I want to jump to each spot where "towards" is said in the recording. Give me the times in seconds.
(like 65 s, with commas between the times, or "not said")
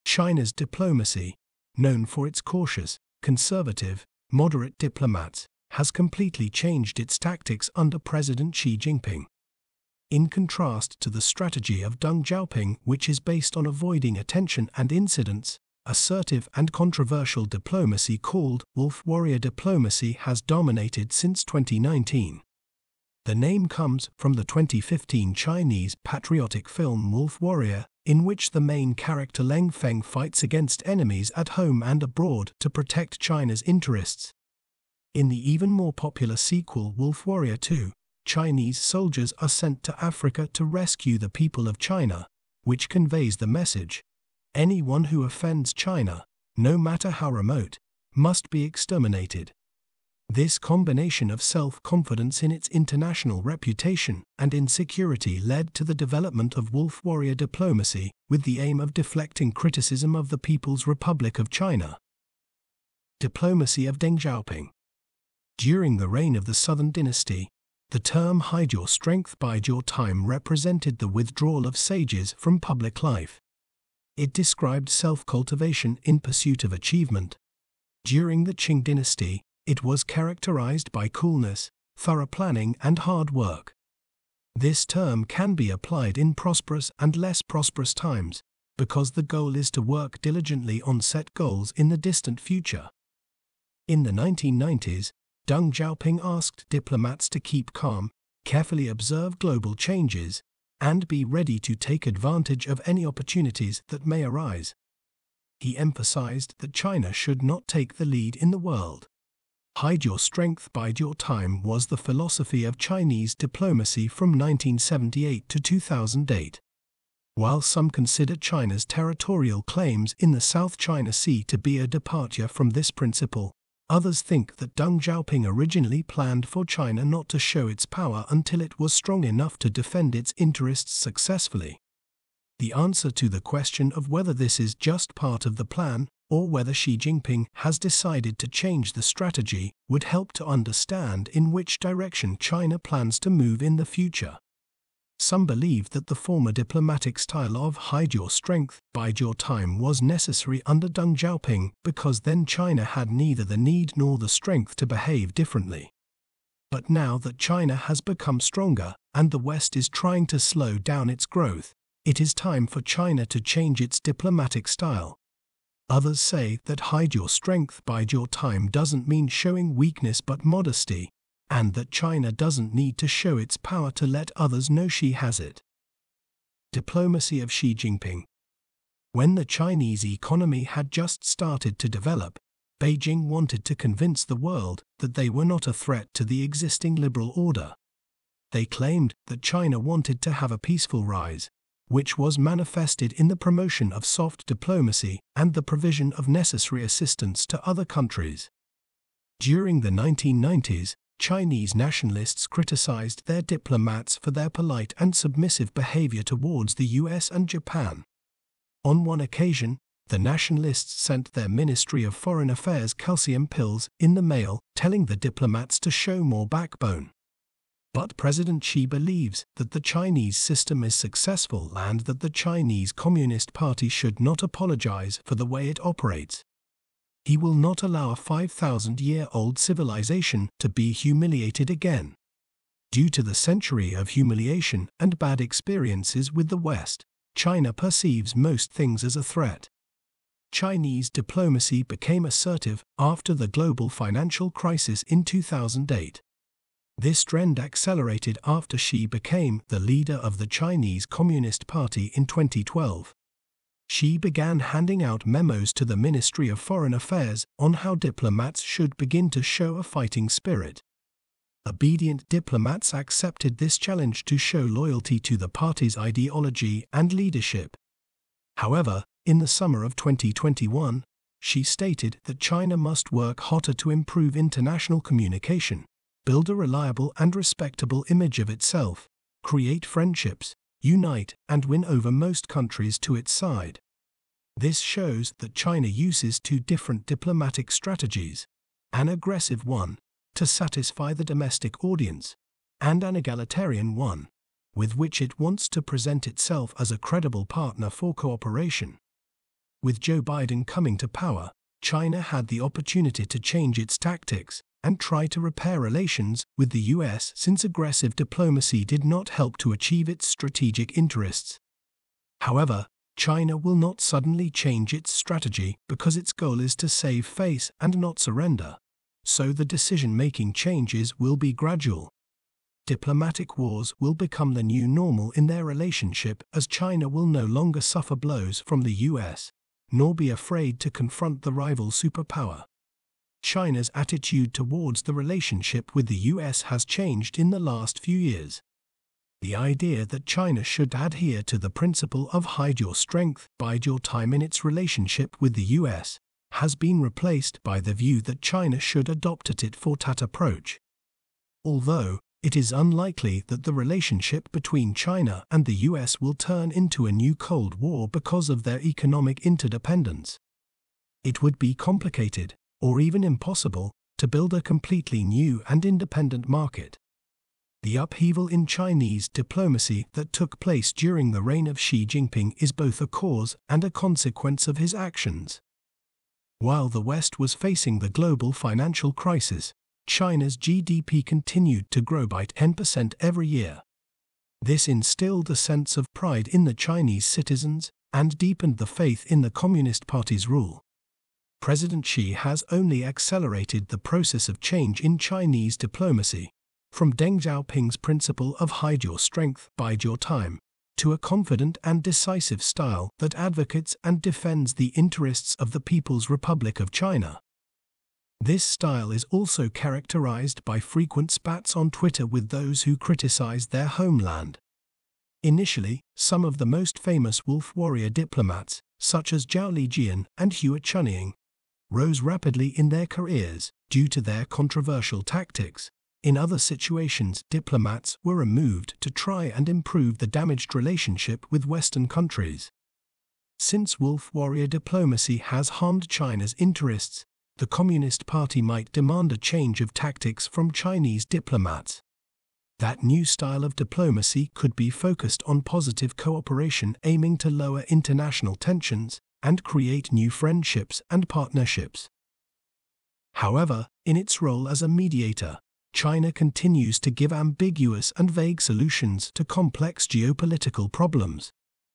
206 s, 334 s.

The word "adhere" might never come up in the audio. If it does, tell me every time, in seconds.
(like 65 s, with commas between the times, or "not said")
340 s.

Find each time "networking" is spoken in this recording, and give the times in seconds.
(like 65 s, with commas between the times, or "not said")
not said.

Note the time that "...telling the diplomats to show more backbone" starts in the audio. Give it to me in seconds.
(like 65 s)
214 s.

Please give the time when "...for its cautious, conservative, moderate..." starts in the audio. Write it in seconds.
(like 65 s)
2 s.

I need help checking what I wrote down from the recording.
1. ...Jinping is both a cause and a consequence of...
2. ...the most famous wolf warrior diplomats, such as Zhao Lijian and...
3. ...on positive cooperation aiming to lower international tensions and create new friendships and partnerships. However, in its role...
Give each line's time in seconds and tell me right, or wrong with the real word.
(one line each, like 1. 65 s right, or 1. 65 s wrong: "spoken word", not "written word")
1. 372 s right
2. 416 s right
3. 445 s right.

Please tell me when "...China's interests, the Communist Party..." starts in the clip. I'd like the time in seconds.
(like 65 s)
436 s.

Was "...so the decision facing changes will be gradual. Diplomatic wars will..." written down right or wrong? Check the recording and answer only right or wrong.
wrong.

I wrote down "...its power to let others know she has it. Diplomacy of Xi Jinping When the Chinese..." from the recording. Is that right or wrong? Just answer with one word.
right.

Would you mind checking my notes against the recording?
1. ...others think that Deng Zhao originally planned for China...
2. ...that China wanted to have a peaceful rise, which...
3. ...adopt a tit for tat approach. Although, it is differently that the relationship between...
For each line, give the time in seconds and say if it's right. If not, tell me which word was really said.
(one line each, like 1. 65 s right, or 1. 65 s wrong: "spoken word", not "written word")
1. 123 s wrong: "Xiaoping", not "Zhao"
2. 189 s right
3. 349 s wrong: "unlikely", not "differently".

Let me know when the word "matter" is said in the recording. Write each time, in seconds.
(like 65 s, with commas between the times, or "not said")
46 s.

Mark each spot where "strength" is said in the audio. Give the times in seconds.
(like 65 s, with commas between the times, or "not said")
68 s, 110 s, 148 s, 154 s, 167 s, 342 s, 399 s.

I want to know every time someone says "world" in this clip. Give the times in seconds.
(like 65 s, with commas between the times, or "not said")
108 s, 184 s.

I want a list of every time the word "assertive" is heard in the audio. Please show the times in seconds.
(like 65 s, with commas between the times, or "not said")
15 s, 242 s.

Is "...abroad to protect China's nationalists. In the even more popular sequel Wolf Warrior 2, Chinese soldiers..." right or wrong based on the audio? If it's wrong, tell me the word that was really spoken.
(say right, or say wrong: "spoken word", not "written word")
wrong: "interests", not "nationalists".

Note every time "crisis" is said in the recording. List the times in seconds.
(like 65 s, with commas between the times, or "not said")
244 s, 379 s.